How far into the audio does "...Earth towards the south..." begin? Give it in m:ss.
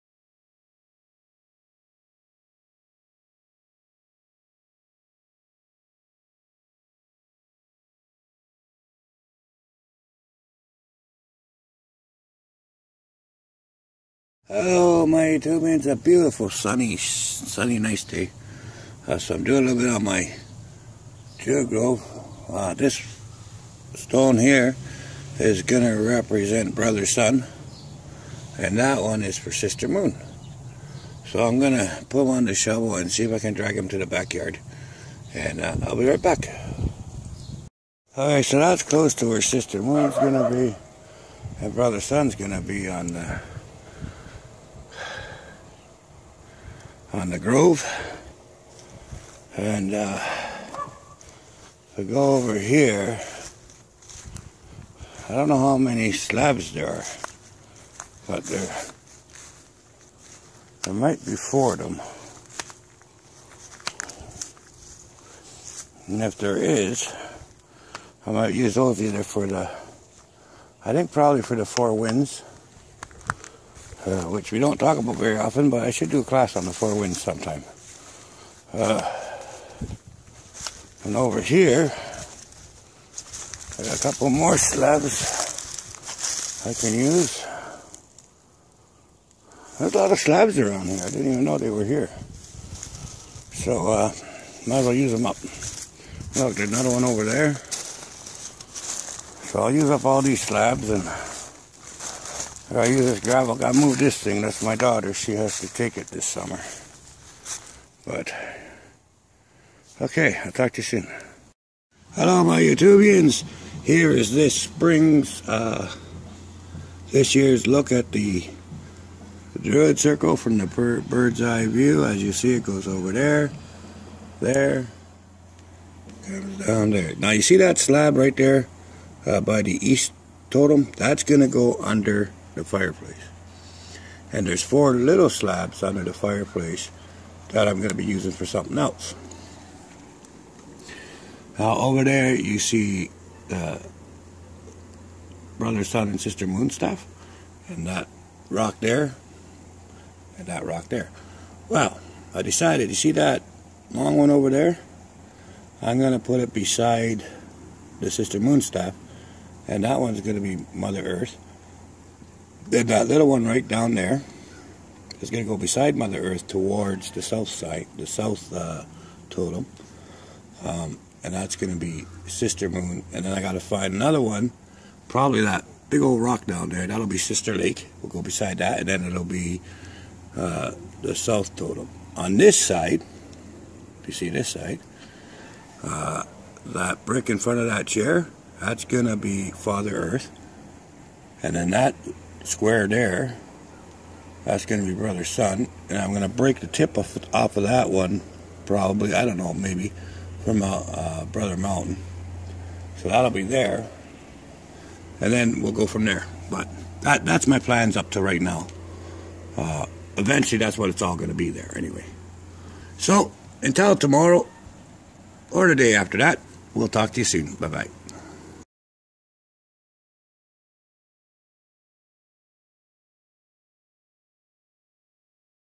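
2:46.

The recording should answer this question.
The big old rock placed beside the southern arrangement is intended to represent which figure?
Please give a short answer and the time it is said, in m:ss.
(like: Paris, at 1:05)
Sister Lake, at 2:57.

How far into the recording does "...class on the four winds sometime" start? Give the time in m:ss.
1:16.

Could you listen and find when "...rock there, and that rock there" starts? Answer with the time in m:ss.
2:28.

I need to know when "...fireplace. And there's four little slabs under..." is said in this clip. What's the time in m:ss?
2:12.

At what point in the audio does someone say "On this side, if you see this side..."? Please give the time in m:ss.
3:02.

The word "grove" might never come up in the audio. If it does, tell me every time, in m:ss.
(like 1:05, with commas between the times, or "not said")
0:21, 0:47.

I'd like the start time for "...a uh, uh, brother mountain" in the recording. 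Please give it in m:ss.
3:20.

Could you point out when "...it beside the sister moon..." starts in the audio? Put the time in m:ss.
2:36.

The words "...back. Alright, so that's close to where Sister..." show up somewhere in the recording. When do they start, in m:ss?
0:36.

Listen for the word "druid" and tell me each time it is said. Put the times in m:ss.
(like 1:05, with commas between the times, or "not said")
0:21, 1:59.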